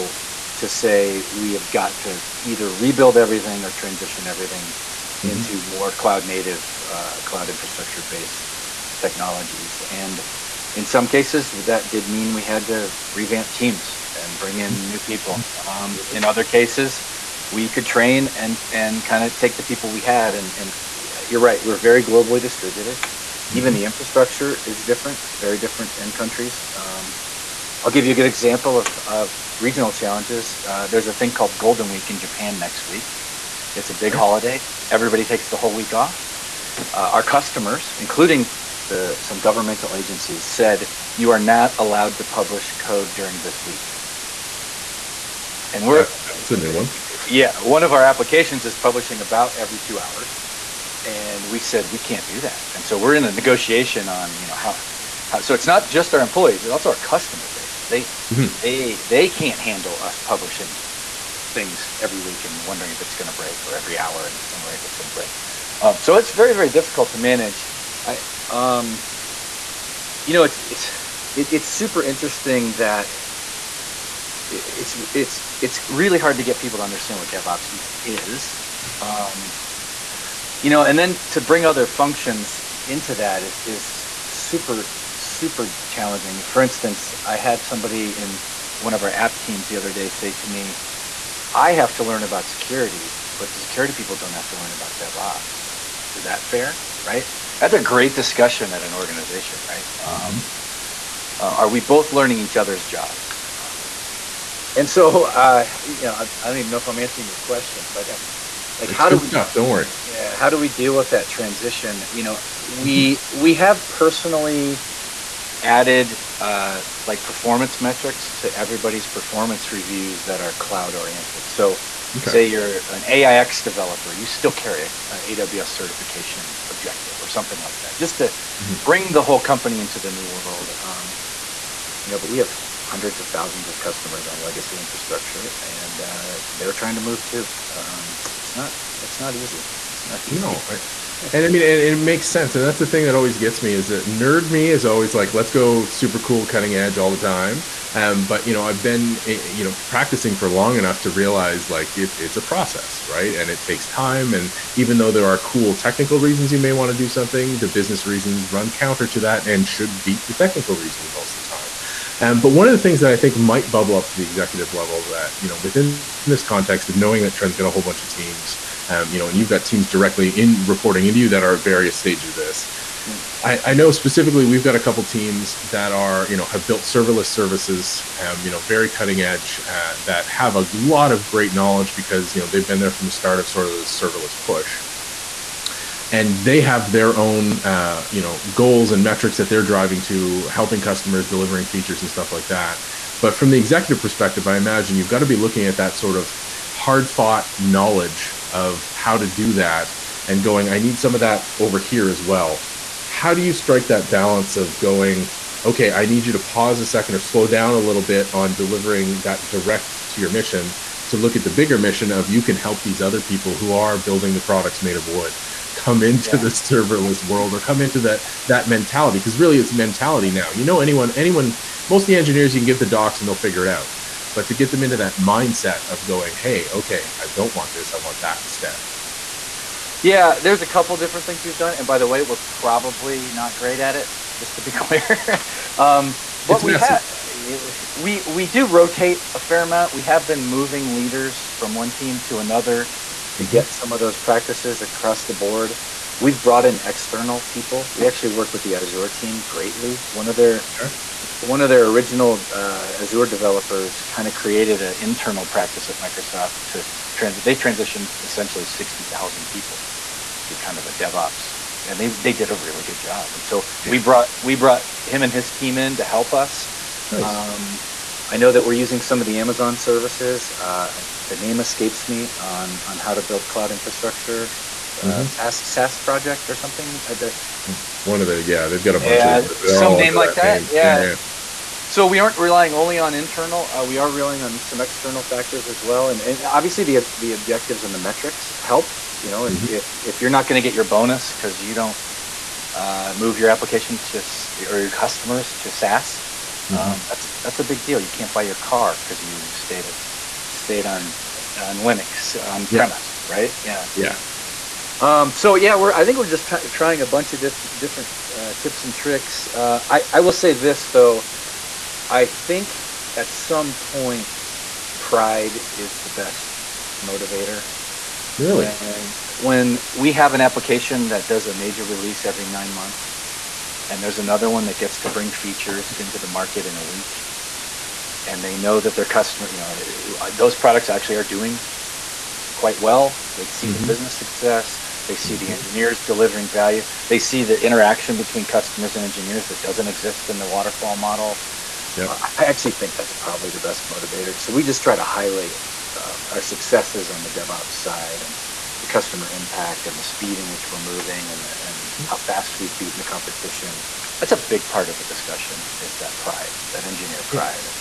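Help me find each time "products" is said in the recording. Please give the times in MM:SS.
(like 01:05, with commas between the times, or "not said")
03:34, 05:30.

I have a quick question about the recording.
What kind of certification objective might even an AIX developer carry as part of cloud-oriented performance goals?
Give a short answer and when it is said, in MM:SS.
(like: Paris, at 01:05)
AWS certification, at 02:05.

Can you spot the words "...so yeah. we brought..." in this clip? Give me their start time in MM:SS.
04:23.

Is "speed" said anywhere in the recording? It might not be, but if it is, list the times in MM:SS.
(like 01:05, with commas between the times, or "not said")
05:50.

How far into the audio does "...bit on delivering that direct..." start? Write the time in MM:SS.
03:28.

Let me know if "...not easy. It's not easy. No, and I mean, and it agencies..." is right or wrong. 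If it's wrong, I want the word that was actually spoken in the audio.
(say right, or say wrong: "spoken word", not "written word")
wrong: "makes", not "agencies".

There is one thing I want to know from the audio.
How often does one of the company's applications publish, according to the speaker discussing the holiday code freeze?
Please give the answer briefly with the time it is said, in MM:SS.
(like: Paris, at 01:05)
every two hours, at 00:49.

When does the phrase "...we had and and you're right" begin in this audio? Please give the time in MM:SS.
00:19.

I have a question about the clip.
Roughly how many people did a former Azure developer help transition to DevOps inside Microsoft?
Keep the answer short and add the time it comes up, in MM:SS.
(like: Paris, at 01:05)
60,000, at 04:18.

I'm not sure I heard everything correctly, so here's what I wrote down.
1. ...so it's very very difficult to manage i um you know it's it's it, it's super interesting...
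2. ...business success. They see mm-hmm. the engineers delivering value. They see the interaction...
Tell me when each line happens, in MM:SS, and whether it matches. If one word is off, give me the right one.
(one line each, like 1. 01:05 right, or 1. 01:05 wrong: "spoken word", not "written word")
1. 01:06 right
2. 05:33 right.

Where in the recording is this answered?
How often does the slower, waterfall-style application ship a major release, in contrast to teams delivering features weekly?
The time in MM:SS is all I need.
05:22.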